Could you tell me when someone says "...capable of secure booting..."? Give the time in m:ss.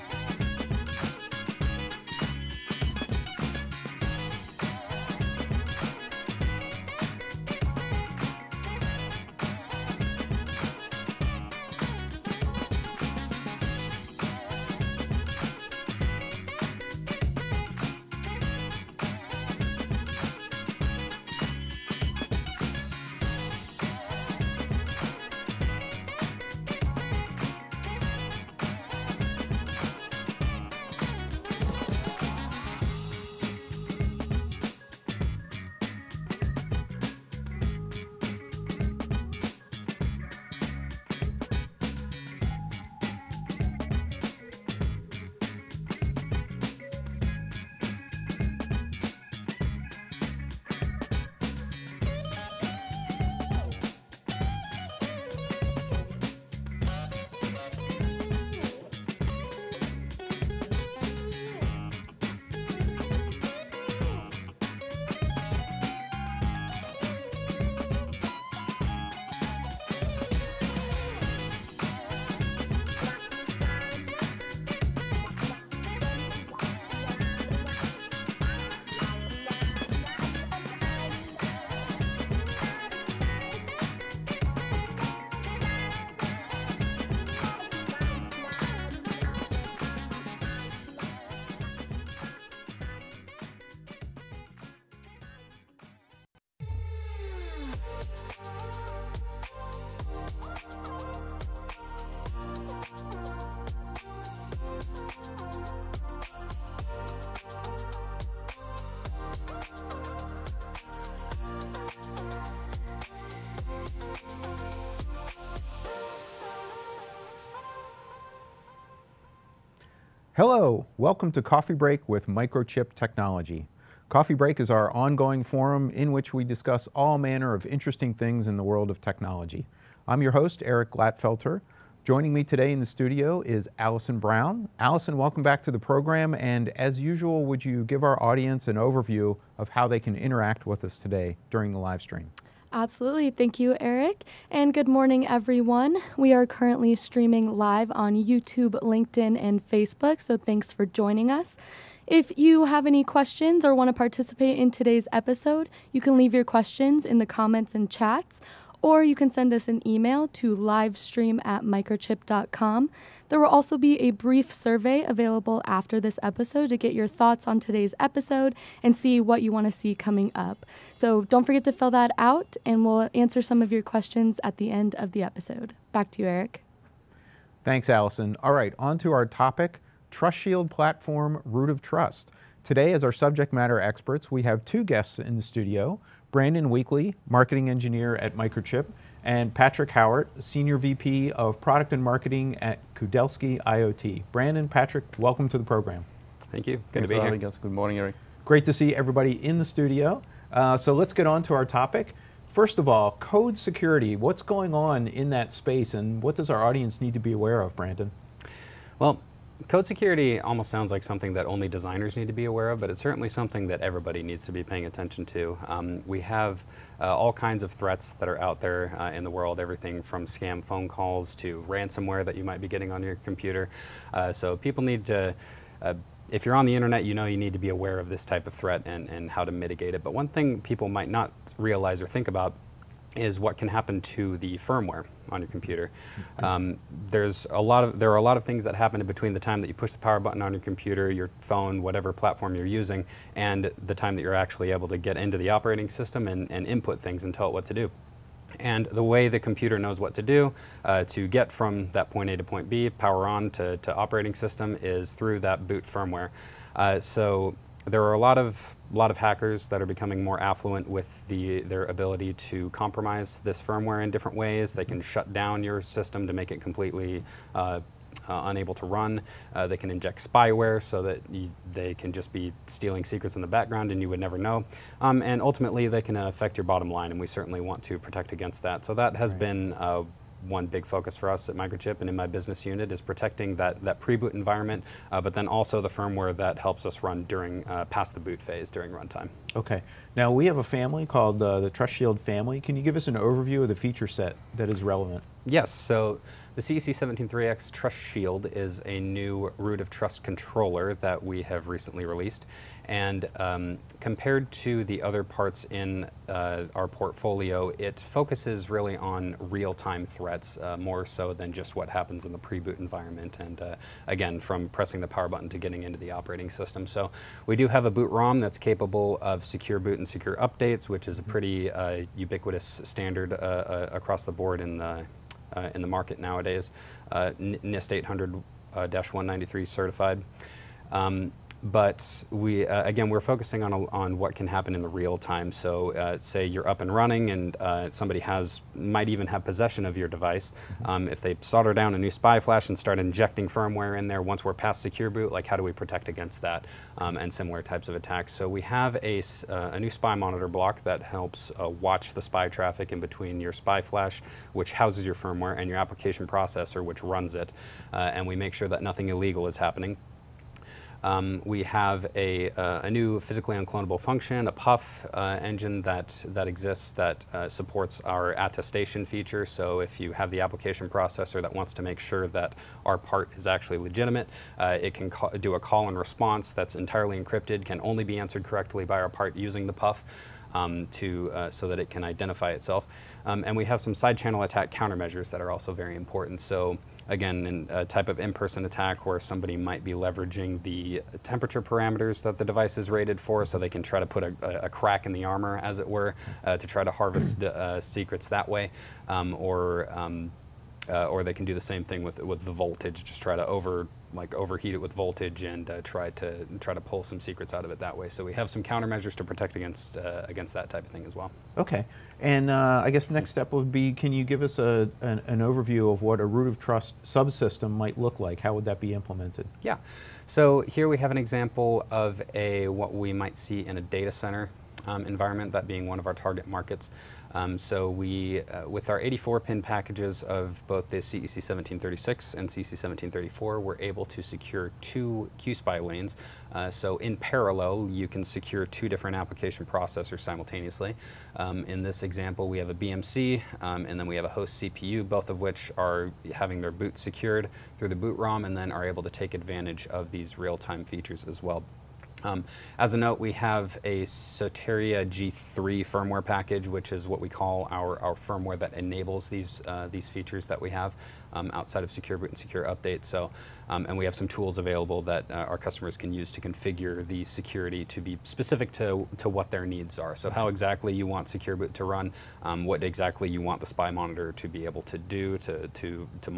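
5:18.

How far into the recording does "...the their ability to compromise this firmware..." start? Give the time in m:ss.
4:21.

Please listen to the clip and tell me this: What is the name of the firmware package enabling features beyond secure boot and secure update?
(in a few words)
Soteria G3.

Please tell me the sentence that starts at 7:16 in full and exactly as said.
Uh, so in parallel, you can secure two different application processors simultaneously.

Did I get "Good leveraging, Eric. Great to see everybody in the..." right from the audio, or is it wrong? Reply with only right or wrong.
wrong.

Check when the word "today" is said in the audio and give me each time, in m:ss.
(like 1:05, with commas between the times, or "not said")
2:12, 2:20, 2:34, 2:47, 3:02.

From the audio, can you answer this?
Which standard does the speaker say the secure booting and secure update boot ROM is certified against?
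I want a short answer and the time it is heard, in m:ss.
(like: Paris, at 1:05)
NIST 800-193, at 5:27.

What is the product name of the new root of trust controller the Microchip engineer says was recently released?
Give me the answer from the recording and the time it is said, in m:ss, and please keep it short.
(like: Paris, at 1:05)
CEC 173X Trust Shield, at 4:56.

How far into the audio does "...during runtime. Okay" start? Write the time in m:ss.
4:48.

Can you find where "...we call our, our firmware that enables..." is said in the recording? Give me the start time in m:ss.
7:37.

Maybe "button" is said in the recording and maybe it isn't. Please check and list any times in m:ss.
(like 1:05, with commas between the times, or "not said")
4:00, 5:15.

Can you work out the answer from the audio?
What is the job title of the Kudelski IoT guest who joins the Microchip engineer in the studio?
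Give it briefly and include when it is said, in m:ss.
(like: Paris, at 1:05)
Senior VP of product and marketing, at 3:10.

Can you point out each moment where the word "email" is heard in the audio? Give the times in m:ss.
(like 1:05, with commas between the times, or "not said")
2:39.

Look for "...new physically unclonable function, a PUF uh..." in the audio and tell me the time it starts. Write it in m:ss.
6:02.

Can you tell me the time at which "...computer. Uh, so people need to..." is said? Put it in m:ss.
3:43.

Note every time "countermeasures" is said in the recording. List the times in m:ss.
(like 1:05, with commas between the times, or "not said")
6:24, 6:48.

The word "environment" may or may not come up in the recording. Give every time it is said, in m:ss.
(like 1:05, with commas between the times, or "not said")
4:44, 5:12, 7:05.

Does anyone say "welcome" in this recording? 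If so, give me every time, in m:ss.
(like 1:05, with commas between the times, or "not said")
2:00, 2:15, 3:15.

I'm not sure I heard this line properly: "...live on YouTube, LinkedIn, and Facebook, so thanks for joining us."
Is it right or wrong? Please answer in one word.
right.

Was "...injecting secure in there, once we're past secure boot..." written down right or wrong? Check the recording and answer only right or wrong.
wrong.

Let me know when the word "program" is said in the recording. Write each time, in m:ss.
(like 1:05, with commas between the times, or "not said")
2:15, 3:15.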